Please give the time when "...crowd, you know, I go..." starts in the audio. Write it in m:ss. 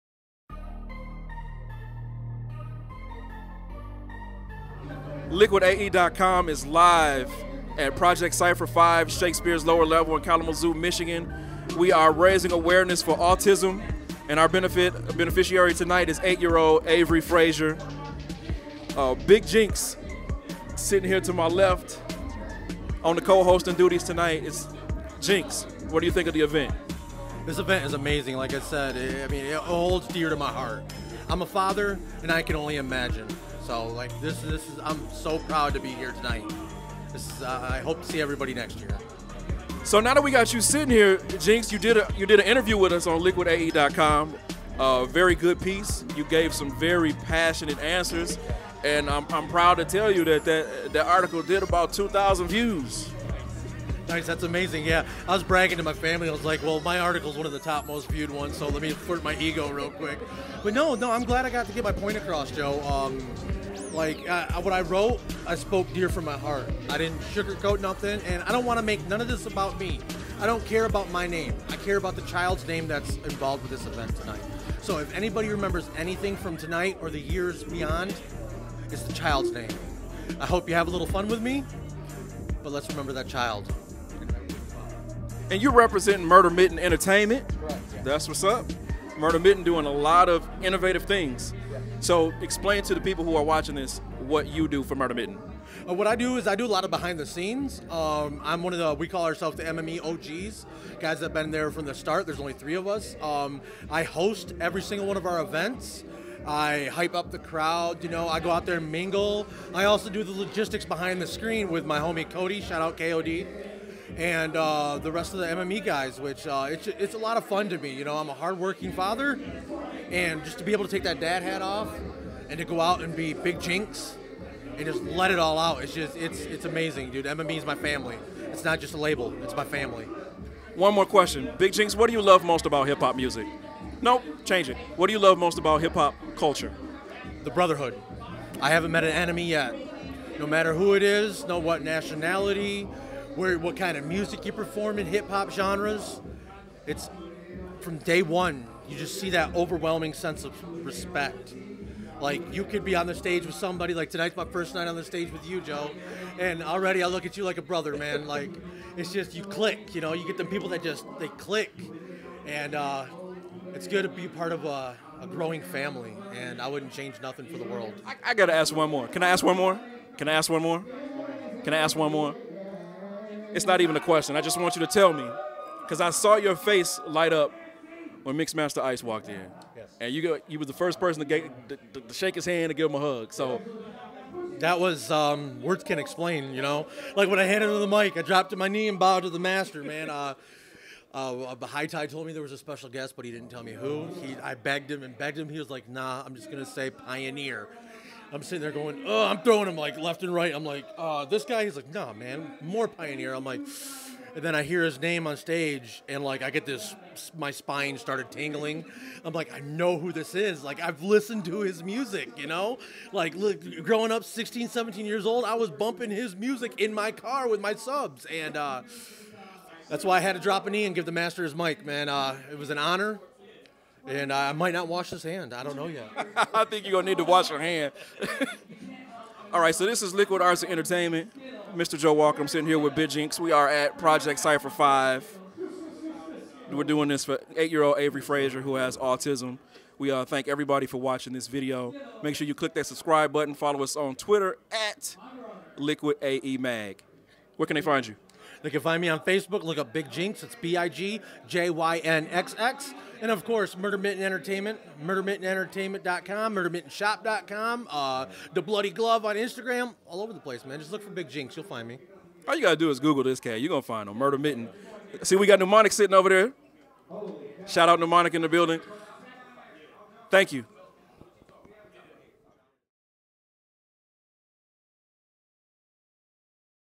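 1:47.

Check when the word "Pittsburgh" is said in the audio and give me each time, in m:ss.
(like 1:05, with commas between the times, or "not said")
not said.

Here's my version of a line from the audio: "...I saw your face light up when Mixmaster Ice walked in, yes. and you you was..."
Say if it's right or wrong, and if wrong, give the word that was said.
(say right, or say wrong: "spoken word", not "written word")
right.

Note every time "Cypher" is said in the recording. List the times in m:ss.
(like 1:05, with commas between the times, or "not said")
0:08, 3:54.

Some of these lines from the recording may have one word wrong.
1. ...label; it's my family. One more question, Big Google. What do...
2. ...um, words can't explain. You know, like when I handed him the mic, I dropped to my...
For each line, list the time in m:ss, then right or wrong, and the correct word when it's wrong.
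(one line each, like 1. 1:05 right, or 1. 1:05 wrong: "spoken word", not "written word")
1. 2:08 wrong: "JynXx", not "Google"
2. 3:05 right.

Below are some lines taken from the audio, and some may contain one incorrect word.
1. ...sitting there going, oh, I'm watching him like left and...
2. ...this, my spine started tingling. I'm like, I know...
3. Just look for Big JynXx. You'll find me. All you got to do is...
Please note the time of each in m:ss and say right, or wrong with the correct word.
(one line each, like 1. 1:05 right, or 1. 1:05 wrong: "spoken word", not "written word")
1. 3:18 wrong: "throwing", not "watching"
2. 3:26 right
3. 4:20 right.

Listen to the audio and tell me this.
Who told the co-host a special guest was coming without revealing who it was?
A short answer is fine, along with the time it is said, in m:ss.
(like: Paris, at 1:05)
High Tide, at 3:11.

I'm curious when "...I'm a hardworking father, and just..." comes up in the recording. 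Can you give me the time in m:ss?
1:58.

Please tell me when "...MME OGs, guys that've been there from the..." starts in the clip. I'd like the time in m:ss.
1:39.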